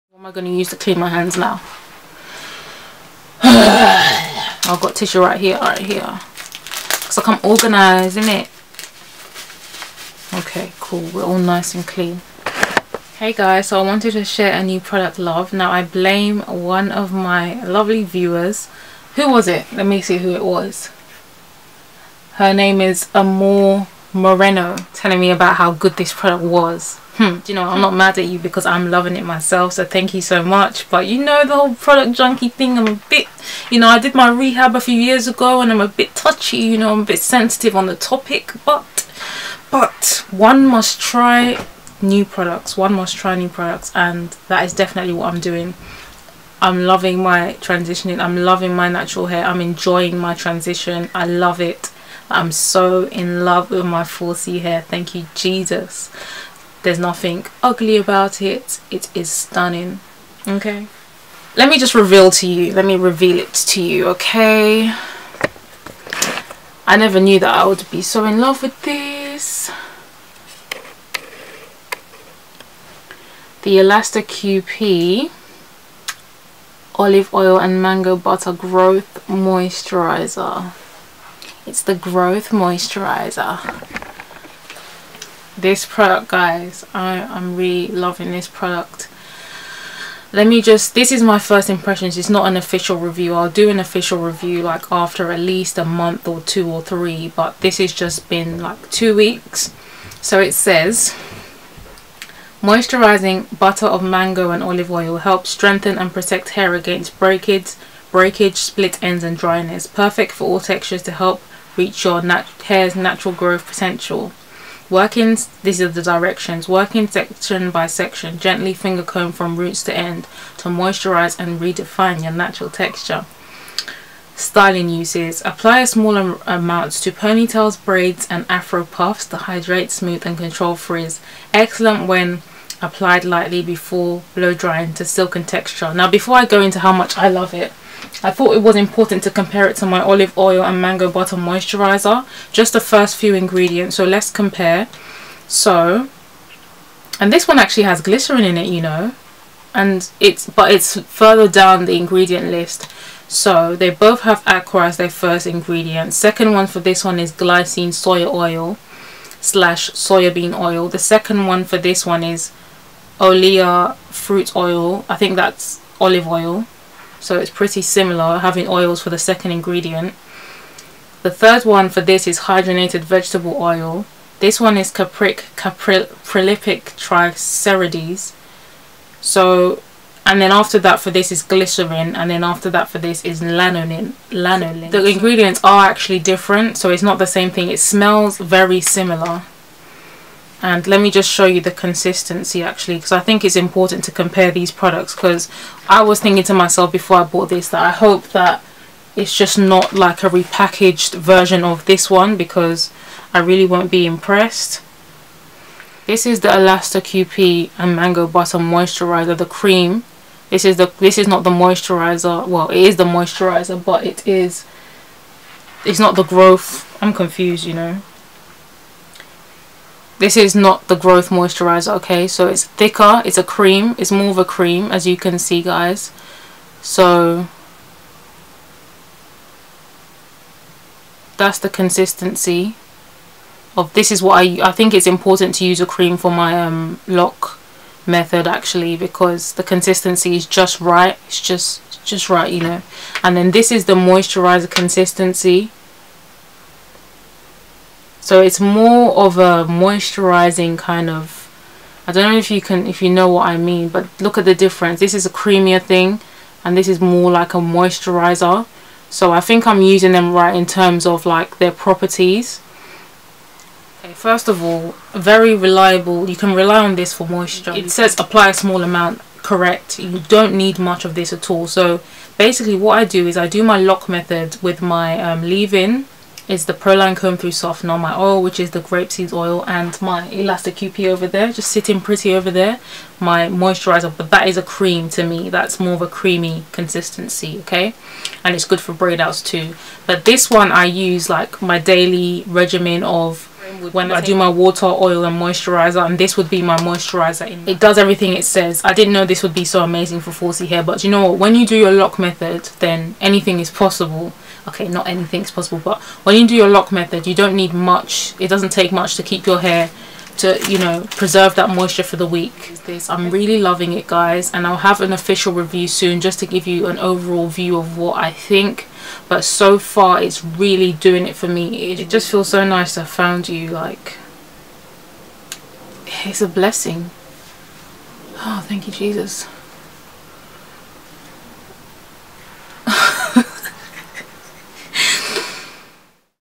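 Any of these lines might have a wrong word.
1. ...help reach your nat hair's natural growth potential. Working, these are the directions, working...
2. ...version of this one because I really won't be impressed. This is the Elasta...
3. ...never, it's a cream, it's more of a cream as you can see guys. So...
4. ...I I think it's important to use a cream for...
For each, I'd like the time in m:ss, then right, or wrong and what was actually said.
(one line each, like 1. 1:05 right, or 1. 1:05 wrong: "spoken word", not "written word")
1. 1:51 right
2. 3:21 right
3. 3:42 wrong: "thicker", not "never"
4. 3:54 right.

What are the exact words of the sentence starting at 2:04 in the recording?
Styling uses, apply a small am amount to ponytails, braids and afro puffs to hydrate, smooth and control frizz.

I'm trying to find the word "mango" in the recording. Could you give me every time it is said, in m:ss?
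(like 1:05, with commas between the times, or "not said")
1:17, 1:44, 2:20, 3:27.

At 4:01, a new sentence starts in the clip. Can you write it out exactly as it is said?
It's just just right, you know.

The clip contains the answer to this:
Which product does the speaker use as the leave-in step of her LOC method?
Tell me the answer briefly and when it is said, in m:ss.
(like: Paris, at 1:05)
Proline Comb Thru Softener, at 4:36.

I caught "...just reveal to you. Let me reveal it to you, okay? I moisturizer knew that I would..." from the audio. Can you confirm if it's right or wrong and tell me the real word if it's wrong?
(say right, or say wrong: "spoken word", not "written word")
wrong: "never", not "moisturizer".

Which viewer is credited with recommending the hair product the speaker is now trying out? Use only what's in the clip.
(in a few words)
Amore Moreno.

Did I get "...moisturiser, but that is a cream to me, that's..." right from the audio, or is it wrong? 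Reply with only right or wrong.
right.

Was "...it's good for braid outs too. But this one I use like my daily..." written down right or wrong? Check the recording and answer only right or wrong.
right.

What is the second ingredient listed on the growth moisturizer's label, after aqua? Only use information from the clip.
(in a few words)
soybean oil.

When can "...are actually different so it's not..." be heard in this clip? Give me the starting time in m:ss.
3:05.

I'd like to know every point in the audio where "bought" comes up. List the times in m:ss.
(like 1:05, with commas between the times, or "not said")
3:17.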